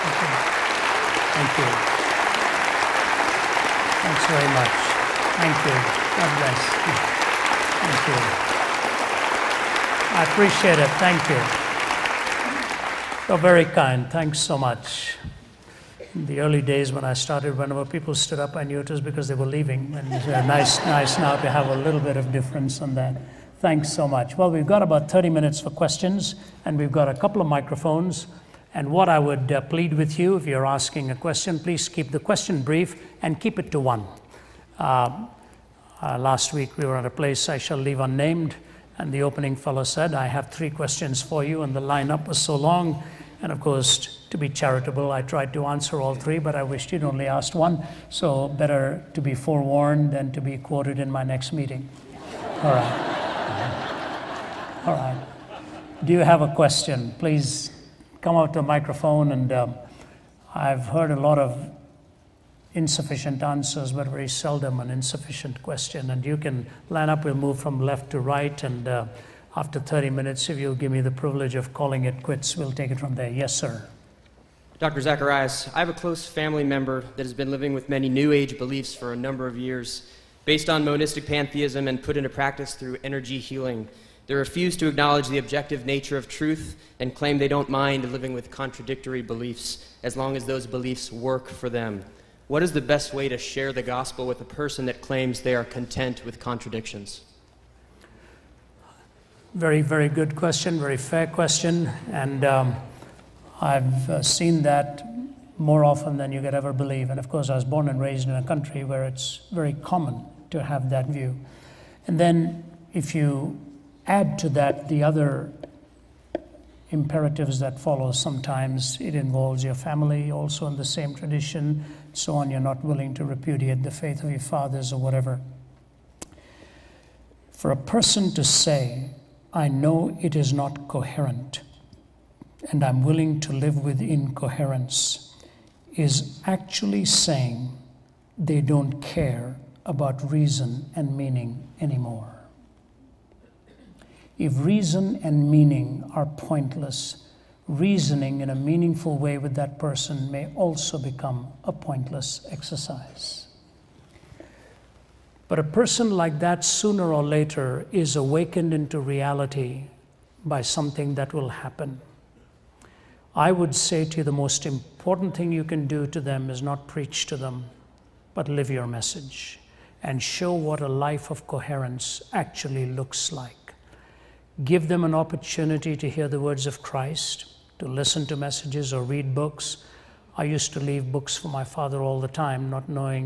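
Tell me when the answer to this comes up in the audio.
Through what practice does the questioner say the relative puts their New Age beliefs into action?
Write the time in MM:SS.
01:23.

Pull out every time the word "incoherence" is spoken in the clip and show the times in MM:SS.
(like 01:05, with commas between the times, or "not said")
02:13.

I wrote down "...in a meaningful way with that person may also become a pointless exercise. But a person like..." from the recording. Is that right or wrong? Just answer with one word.
right.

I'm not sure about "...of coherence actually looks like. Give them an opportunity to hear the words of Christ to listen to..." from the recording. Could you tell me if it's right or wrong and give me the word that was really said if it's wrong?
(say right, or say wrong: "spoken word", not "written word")
right.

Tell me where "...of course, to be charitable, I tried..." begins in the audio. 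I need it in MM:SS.
00:43.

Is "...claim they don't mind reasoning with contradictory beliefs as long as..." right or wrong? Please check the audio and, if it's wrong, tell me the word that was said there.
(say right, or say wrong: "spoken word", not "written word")
wrong: "living", not "reasoning".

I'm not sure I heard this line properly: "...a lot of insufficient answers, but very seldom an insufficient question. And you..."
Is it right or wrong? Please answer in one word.
right.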